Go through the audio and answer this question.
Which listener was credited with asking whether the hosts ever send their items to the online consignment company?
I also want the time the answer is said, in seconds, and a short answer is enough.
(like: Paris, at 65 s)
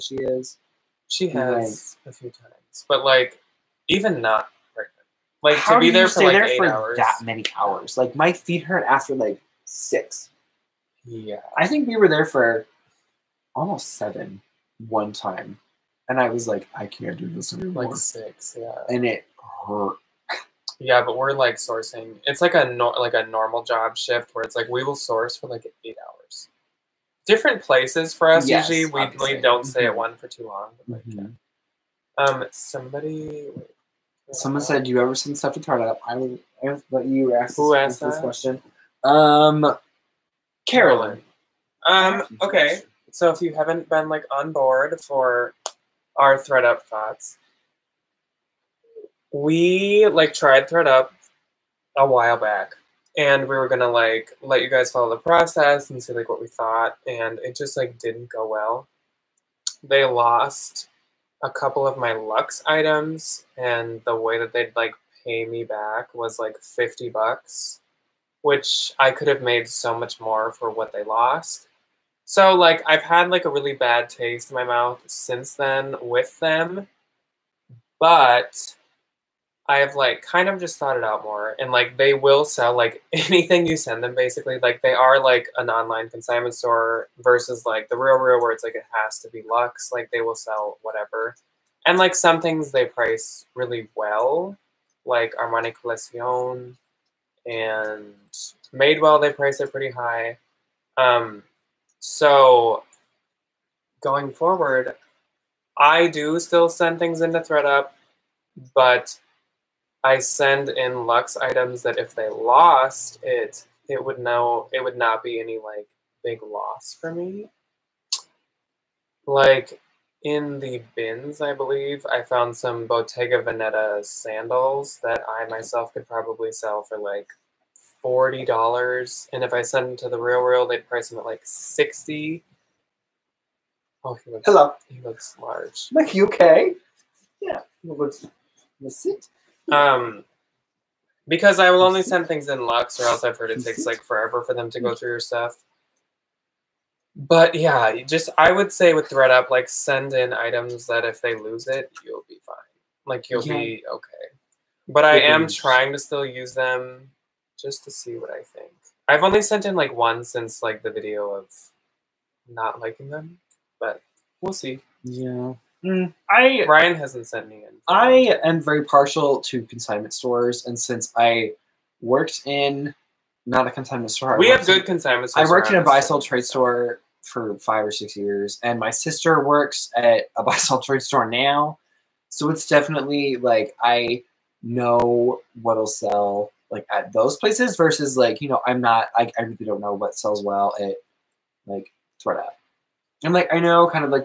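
Carolyn, at 40 s.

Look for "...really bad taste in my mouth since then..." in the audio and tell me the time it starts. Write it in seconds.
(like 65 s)
73 s.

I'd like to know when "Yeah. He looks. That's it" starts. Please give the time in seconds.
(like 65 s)
137 s.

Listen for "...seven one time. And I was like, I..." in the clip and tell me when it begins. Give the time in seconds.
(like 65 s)
13 s.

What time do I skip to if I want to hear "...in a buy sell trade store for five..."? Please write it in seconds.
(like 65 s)
175 s.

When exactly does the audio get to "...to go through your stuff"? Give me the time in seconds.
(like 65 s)
144 s.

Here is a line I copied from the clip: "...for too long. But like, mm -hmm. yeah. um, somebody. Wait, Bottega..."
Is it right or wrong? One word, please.
wrong.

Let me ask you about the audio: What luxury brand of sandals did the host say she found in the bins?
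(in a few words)
Bottega Veneta.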